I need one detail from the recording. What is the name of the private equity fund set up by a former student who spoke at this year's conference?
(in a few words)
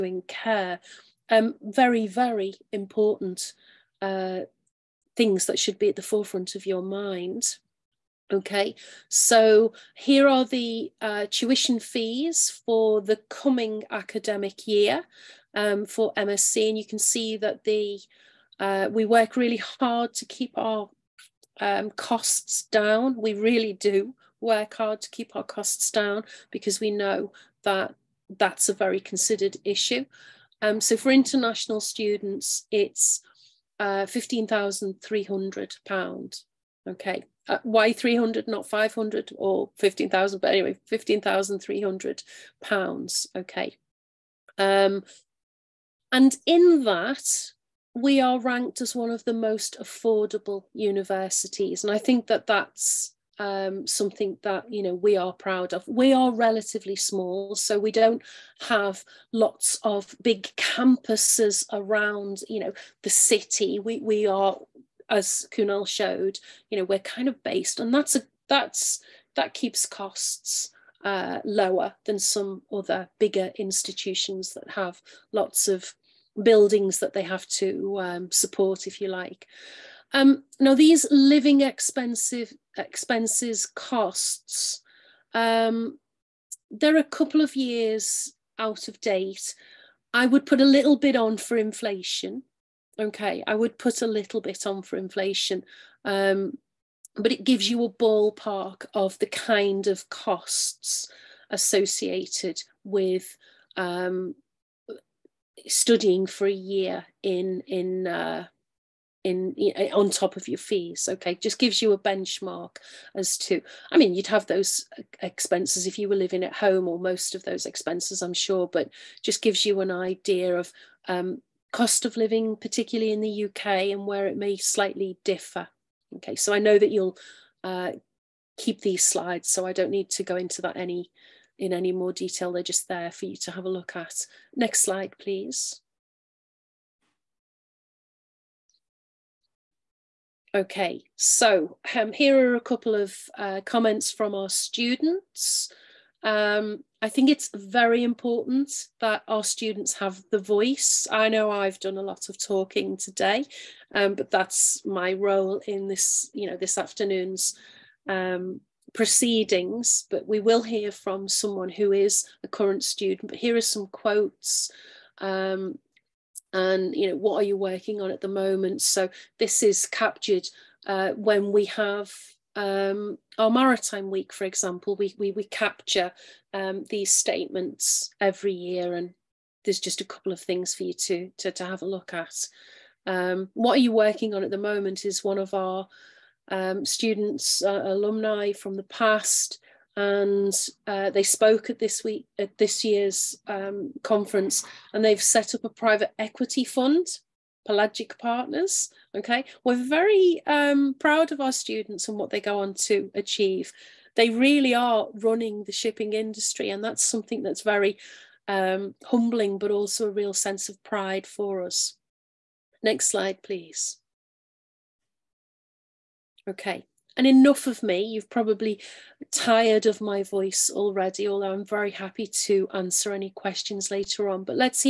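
Pelagic Partners.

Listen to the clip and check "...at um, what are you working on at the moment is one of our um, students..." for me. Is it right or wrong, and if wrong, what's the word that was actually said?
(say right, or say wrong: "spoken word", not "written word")
right.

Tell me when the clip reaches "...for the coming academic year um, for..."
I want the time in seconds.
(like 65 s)
12 s.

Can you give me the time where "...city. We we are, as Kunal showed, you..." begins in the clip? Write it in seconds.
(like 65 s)
63 s.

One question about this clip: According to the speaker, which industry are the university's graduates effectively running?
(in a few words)
Shipping.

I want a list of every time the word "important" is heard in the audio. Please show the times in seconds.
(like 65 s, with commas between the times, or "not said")
2 s, 148 s.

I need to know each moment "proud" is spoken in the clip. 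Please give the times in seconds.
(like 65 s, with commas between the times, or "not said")
55 s, 200 s.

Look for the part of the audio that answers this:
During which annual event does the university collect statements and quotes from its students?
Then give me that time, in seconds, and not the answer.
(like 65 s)
173 s.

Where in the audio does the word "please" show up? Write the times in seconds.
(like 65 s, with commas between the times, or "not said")
135 s, 213 s.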